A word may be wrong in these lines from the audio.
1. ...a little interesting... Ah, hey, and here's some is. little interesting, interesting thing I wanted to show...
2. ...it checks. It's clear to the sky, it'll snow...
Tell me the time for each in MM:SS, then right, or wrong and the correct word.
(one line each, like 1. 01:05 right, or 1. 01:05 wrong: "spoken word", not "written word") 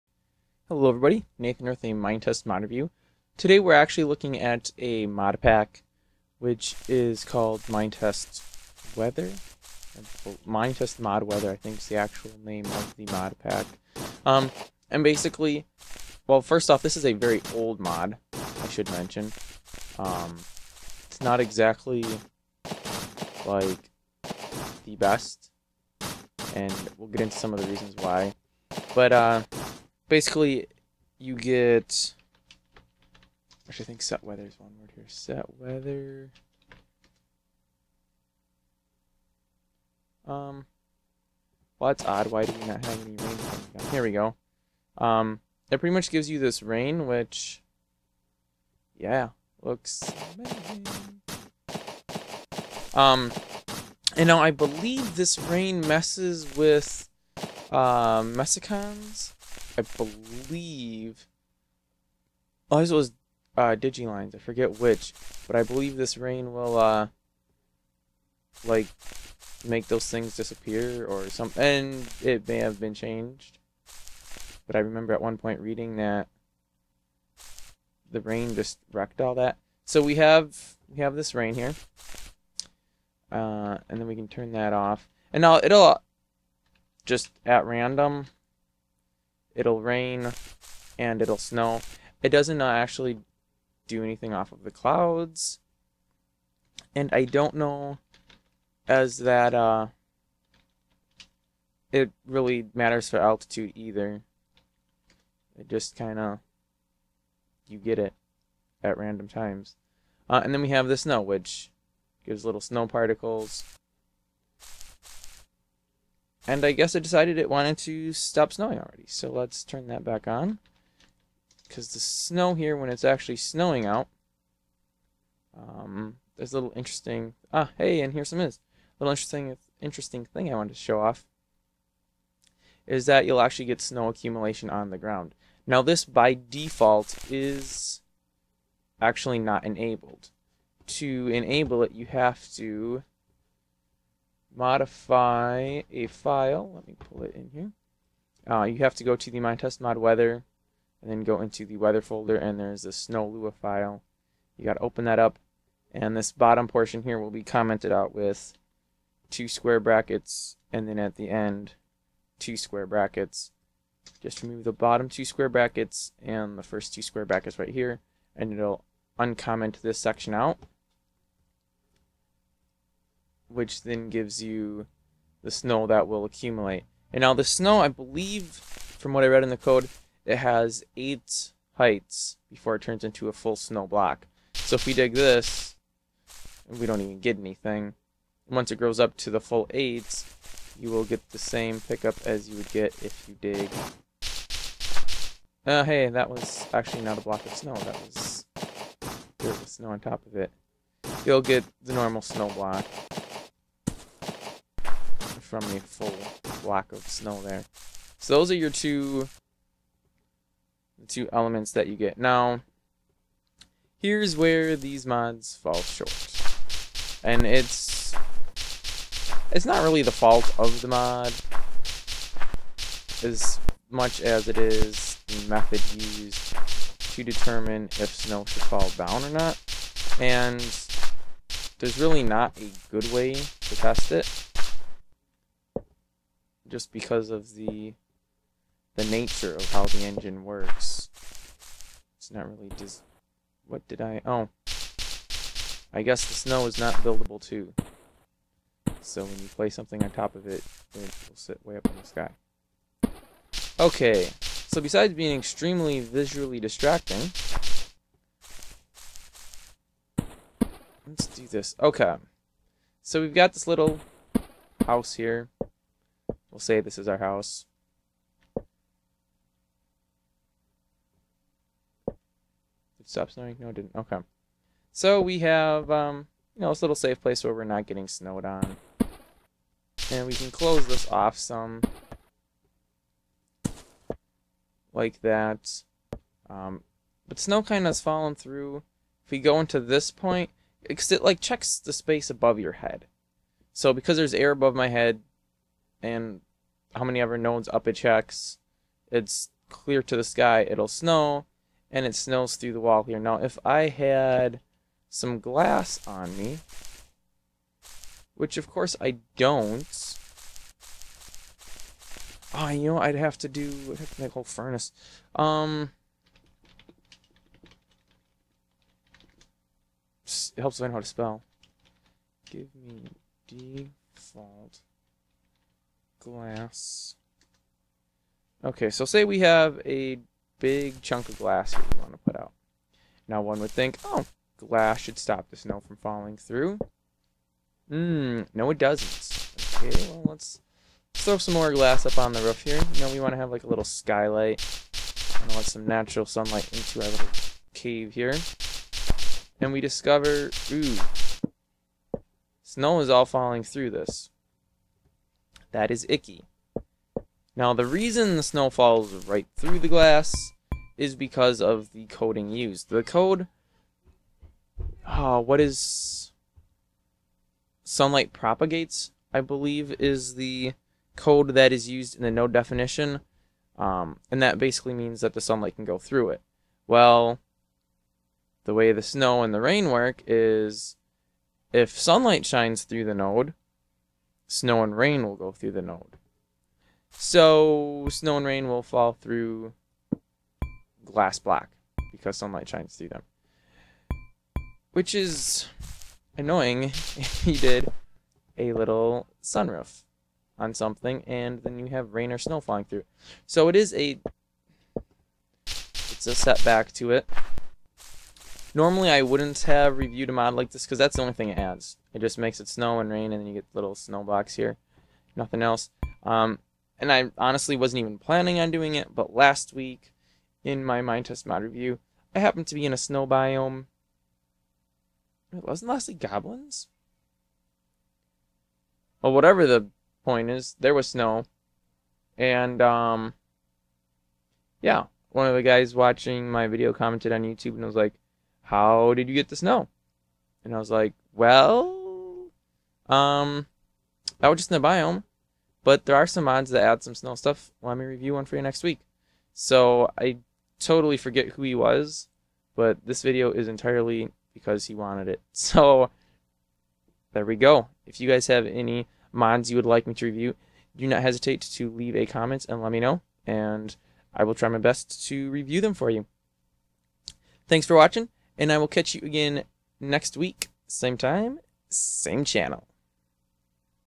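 1. 02:06 right
2. 04:57 right.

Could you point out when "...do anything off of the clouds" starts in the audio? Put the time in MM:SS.
01:33.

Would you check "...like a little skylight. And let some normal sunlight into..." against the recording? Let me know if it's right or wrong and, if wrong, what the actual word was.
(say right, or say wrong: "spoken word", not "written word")
wrong: "natural", not "normal".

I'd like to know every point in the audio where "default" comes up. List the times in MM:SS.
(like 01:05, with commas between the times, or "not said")
02:16, 05:23.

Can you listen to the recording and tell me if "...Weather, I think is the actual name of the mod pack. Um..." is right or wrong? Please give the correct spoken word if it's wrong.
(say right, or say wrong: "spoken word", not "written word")
right.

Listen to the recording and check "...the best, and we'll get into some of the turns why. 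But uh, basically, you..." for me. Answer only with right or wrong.
wrong.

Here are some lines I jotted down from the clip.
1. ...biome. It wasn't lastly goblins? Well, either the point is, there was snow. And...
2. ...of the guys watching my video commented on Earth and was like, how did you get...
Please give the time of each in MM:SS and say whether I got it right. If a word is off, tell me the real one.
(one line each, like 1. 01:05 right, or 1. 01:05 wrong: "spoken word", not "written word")
1. 07:03 wrong: "whatever", not "either"
2. 07:15 wrong: "YouTube", not "Earth".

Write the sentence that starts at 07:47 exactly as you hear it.
Thanks for watching and I will catch you again next week, same time, same channel.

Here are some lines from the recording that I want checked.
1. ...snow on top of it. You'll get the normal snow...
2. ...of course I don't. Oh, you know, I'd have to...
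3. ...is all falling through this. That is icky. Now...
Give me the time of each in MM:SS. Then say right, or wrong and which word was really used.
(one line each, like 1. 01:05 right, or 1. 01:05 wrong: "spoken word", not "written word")
1. 03:19 right
2. 05:08 right
3. 05:52 right.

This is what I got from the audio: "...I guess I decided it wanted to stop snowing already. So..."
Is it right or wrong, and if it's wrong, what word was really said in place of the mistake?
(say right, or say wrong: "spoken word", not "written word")
right.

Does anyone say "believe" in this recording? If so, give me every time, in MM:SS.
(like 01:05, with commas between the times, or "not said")
00:54, 00:59, 01:05, 02:57, 06:09.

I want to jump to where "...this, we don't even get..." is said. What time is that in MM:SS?
03:05.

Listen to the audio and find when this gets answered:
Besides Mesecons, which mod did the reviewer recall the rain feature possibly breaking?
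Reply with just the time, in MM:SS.
01:03.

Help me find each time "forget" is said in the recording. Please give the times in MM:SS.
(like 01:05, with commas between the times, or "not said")
01:04, 07:31.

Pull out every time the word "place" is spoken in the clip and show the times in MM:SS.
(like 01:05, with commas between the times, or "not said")
04:09, 04:37.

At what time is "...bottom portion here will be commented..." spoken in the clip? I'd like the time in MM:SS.
02:36.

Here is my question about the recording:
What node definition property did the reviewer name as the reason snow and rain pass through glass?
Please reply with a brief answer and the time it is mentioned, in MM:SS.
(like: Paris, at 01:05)
Sunlight propagates, at 06:07.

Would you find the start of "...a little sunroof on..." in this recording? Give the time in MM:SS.
06:38.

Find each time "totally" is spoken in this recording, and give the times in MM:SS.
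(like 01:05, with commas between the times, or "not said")
07:30.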